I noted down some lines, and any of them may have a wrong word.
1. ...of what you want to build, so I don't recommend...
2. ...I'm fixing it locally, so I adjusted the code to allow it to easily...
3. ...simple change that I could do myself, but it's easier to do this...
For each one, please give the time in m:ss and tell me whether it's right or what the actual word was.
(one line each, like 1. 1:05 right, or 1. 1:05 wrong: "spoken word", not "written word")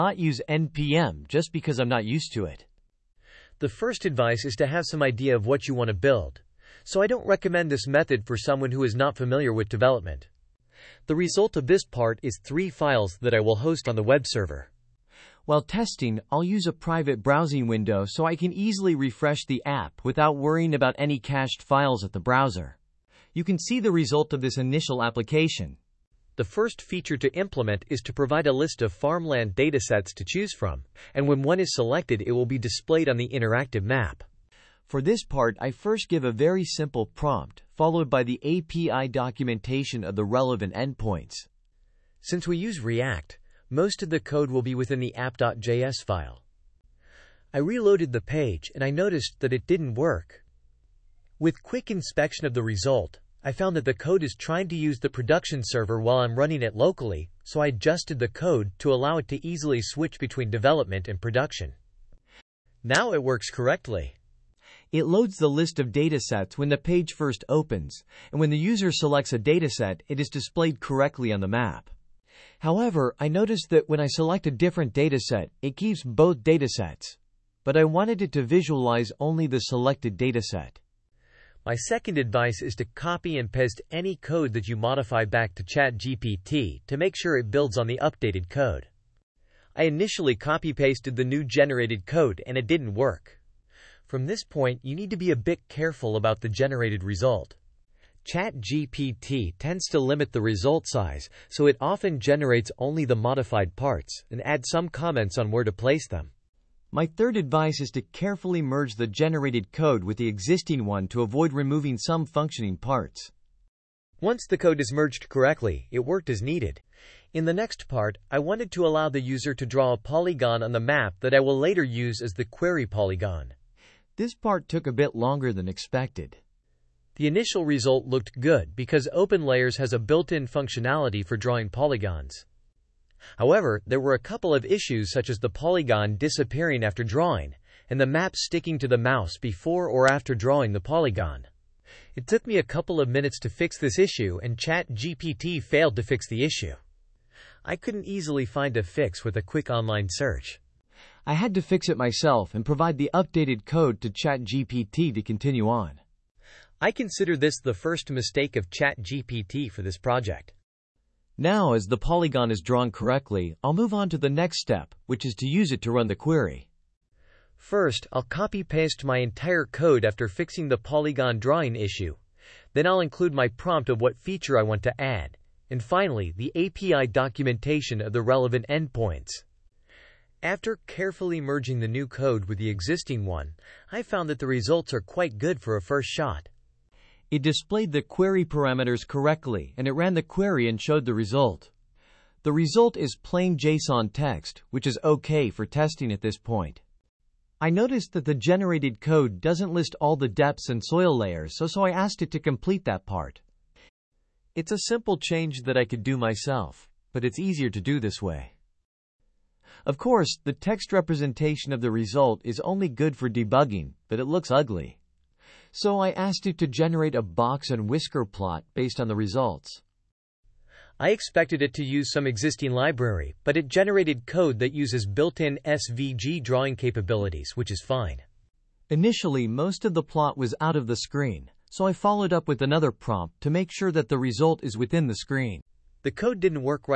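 1. 0:05 right
2. 0:56 wrong: "running", not "fixing"
3. 3:24 right.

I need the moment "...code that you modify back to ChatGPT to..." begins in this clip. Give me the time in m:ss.
1:24.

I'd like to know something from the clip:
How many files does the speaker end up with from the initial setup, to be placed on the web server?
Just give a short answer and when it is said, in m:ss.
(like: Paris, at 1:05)
3, at 0:12.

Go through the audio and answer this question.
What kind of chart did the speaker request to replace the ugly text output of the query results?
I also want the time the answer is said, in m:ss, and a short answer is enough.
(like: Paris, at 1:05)
box and whisker plot, at 3:37.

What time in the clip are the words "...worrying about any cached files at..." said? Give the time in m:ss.
0:20.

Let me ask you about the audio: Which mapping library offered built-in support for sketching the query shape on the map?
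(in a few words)
OpenLayers.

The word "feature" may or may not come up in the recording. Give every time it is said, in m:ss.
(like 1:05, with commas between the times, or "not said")
0:26, 2:54.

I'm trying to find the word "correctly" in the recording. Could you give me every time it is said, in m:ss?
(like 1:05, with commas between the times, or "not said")
1:03, 1:10, 1:55, 2:42, 3:09.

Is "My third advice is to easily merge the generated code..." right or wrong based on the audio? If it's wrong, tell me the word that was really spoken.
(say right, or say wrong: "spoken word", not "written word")
wrong: "carefully", not "easily".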